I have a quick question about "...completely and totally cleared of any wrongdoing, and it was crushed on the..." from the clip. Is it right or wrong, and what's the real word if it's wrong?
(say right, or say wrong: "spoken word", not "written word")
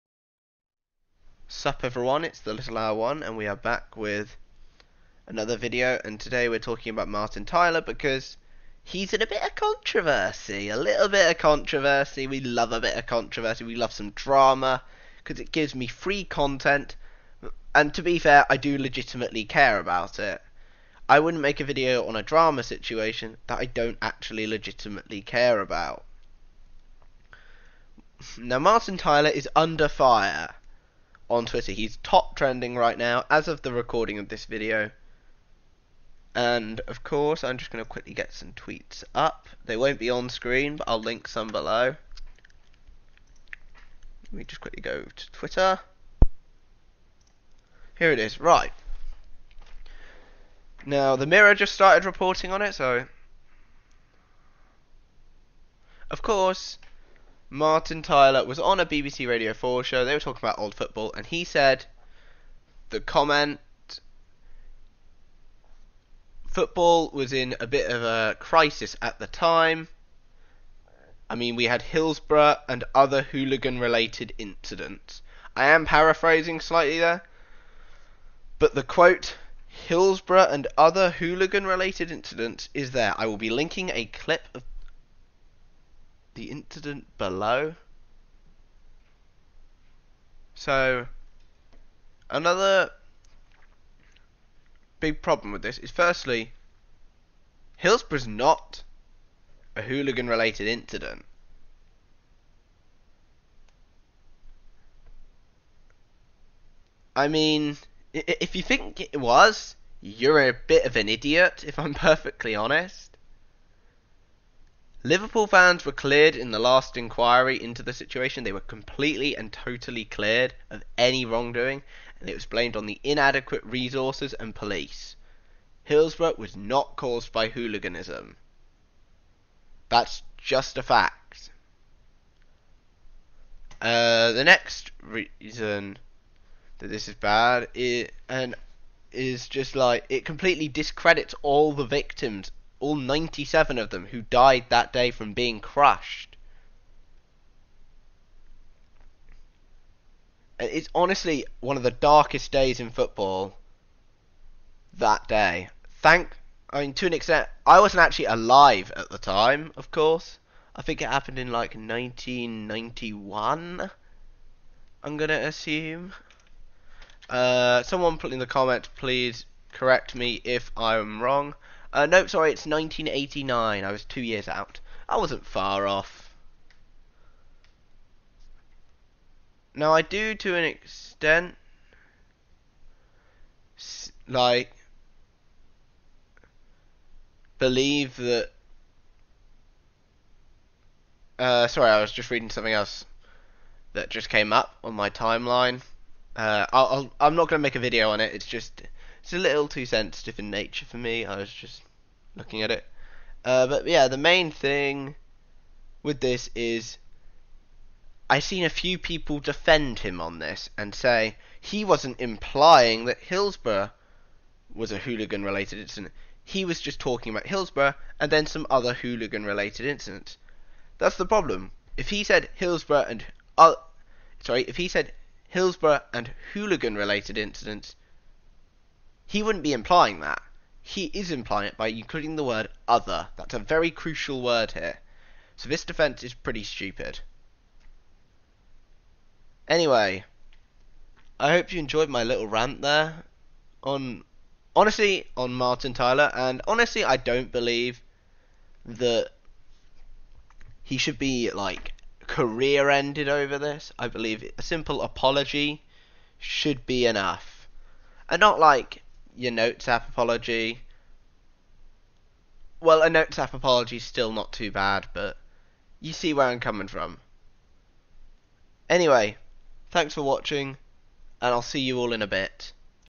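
wrong: "blamed", not "crushed".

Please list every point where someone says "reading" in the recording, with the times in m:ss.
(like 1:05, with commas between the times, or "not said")
3:12.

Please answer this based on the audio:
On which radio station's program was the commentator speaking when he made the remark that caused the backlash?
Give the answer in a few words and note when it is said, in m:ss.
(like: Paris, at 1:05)
BBC Radio 4, at 0:58.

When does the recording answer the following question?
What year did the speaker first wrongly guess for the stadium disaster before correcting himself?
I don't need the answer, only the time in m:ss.
2:41.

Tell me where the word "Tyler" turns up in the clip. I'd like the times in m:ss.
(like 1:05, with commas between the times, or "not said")
0:07, 0:28, 0:58, 4:05.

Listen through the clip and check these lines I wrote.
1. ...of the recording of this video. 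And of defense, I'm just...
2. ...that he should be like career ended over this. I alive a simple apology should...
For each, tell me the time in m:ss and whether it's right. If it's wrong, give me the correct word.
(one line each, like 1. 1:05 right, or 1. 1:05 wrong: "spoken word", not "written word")
1. 0:33 wrong: "course", not "defense"
2. 4:08 wrong: "believe", not "alive".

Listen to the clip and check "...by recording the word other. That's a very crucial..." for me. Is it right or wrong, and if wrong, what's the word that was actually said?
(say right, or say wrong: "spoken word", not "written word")
wrong: "including", not "recording".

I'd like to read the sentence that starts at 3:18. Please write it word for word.
It's just it's a little too sensitive in nature for me.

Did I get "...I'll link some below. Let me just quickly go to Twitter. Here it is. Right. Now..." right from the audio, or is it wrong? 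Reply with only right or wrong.
right.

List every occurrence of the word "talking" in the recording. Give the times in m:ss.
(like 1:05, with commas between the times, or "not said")
0:06, 1:00, 3:36.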